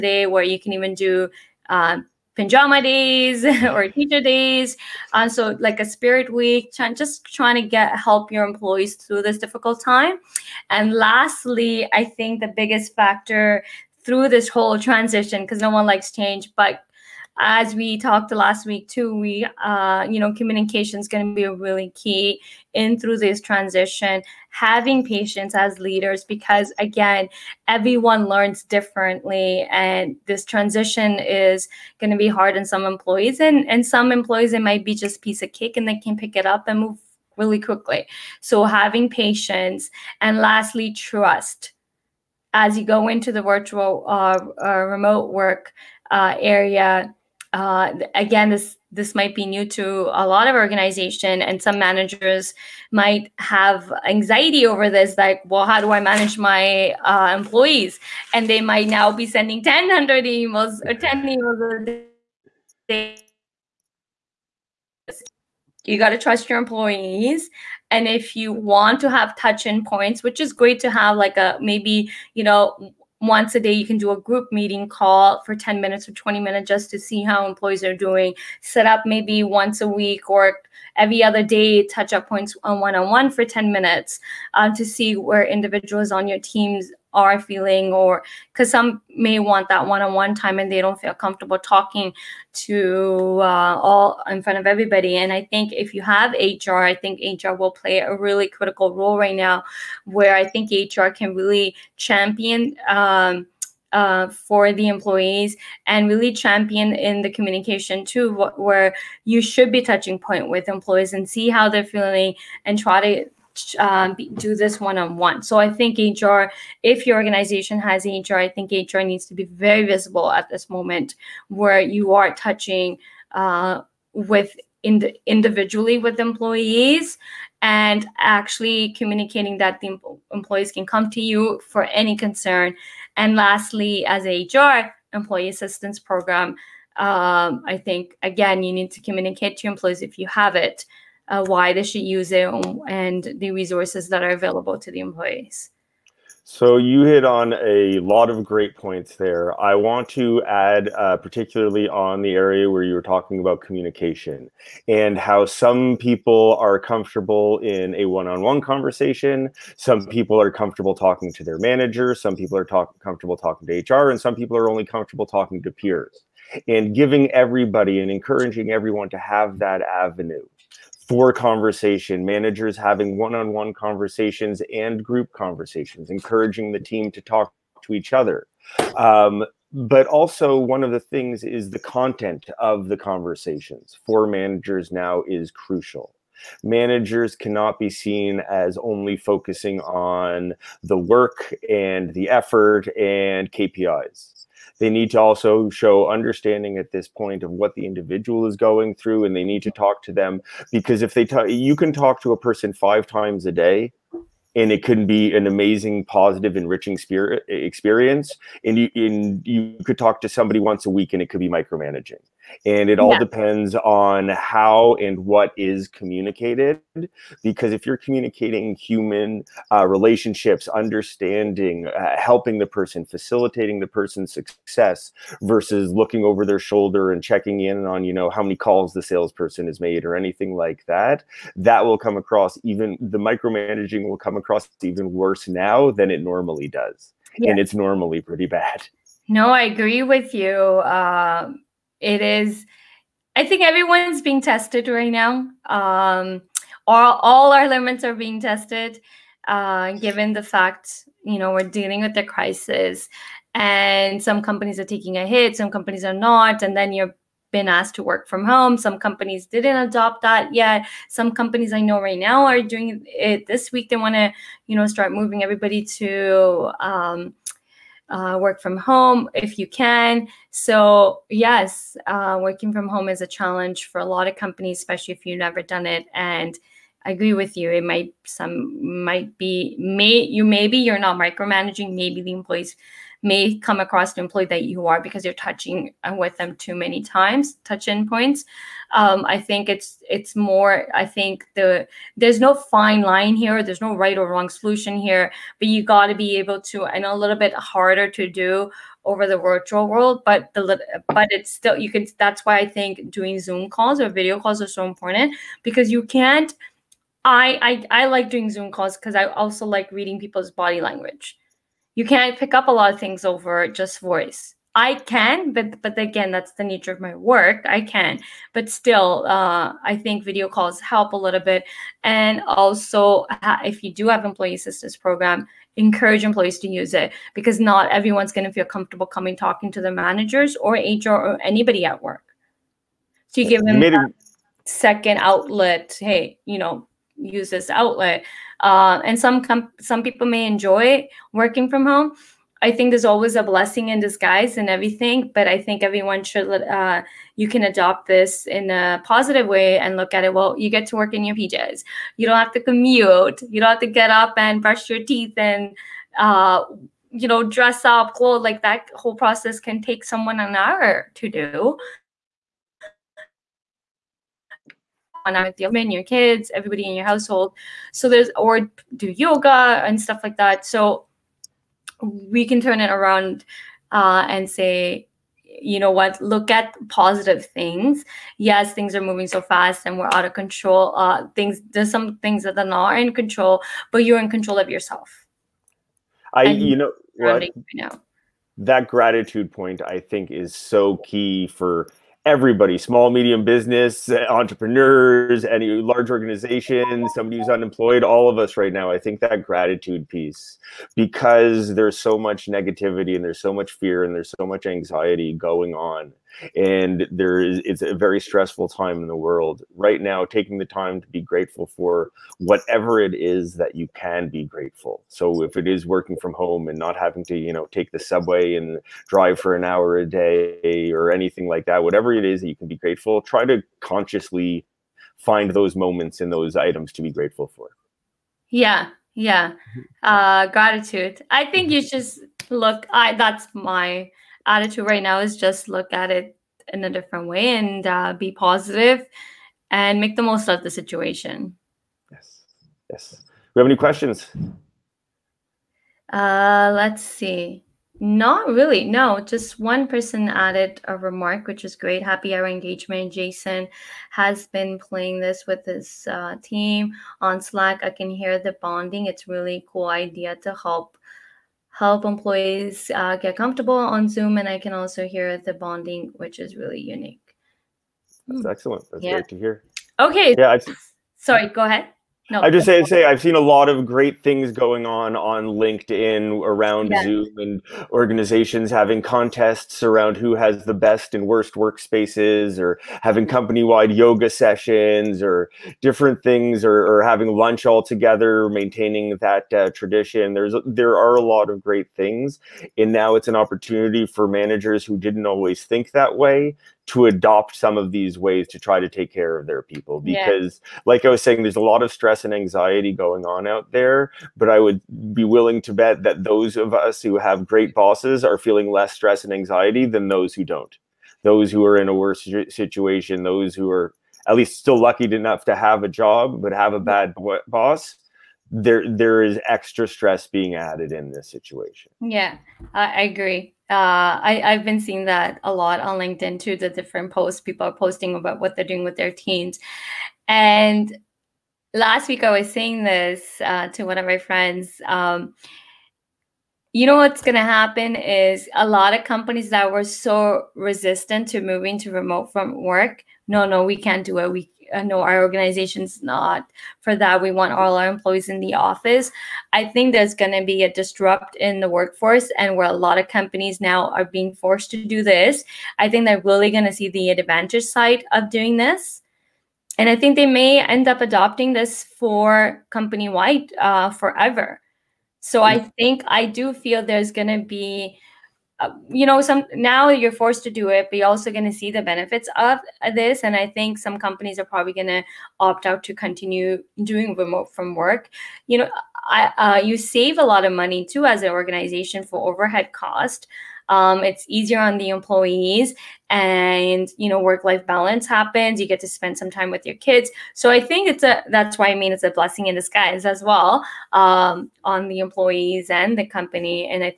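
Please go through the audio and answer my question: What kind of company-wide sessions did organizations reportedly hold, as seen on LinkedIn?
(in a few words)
Yoga sessions.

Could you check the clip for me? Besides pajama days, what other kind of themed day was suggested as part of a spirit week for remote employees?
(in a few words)
Teacher days.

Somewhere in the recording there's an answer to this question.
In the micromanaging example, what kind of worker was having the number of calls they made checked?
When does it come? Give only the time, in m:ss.
3:49.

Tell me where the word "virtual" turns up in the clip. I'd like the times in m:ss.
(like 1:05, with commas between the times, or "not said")
0:43, 4:59.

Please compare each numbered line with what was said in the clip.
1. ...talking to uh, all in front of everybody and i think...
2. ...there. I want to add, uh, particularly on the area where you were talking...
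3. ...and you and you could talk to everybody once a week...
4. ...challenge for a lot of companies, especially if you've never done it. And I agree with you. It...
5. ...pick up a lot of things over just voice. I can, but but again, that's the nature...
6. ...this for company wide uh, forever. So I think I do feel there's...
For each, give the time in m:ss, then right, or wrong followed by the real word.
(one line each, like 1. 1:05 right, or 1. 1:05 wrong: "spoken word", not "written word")
1. 1:31 right
2. 2:29 right
3. 3:28 wrong: "somebody", not "everybody"
4. 4:33 right
5. 5:12 right
6. 9:21 right.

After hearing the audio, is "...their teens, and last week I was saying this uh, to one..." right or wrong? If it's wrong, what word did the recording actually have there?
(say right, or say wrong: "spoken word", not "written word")
right.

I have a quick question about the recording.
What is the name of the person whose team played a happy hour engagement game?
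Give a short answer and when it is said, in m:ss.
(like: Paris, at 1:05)
Jason, at 7:33.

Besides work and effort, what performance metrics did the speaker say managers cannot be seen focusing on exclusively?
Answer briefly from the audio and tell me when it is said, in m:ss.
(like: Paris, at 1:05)
KPIs, at 3:13.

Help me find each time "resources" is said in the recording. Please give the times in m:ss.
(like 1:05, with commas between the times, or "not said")
2:23.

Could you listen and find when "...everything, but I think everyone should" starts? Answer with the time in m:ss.
5:44.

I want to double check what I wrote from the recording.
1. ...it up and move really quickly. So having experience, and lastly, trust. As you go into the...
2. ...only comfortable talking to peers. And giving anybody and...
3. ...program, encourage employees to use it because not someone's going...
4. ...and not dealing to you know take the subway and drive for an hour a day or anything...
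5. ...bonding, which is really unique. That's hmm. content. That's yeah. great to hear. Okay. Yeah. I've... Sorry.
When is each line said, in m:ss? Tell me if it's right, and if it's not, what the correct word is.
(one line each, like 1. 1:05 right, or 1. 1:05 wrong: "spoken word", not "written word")
1. 0:36 wrong: "patience", not "experience"
2. 2:44 wrong: "everybody", not "anybody"
3. 5:24 wrong: "everyone", not "someone"
4. 6:56 wrong: "having", not "dealing"
5. 7:45 wrong: "excellent", not "content".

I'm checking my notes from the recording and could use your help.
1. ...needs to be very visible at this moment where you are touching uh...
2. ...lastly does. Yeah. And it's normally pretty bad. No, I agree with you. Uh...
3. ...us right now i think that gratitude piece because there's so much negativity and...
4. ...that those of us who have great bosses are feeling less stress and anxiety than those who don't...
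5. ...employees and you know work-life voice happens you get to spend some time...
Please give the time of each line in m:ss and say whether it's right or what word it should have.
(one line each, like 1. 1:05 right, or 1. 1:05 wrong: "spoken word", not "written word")
1. 1:59 right
2. 3:56 wrong: "normally", not "lastly"
3. 6:38 right
4. 8:26 right
5. 9:44 wrong: "balance", not "voice".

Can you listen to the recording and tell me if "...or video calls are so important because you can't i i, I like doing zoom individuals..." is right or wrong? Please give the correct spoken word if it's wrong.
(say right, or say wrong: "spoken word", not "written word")
wrong: "calls", not "individuals".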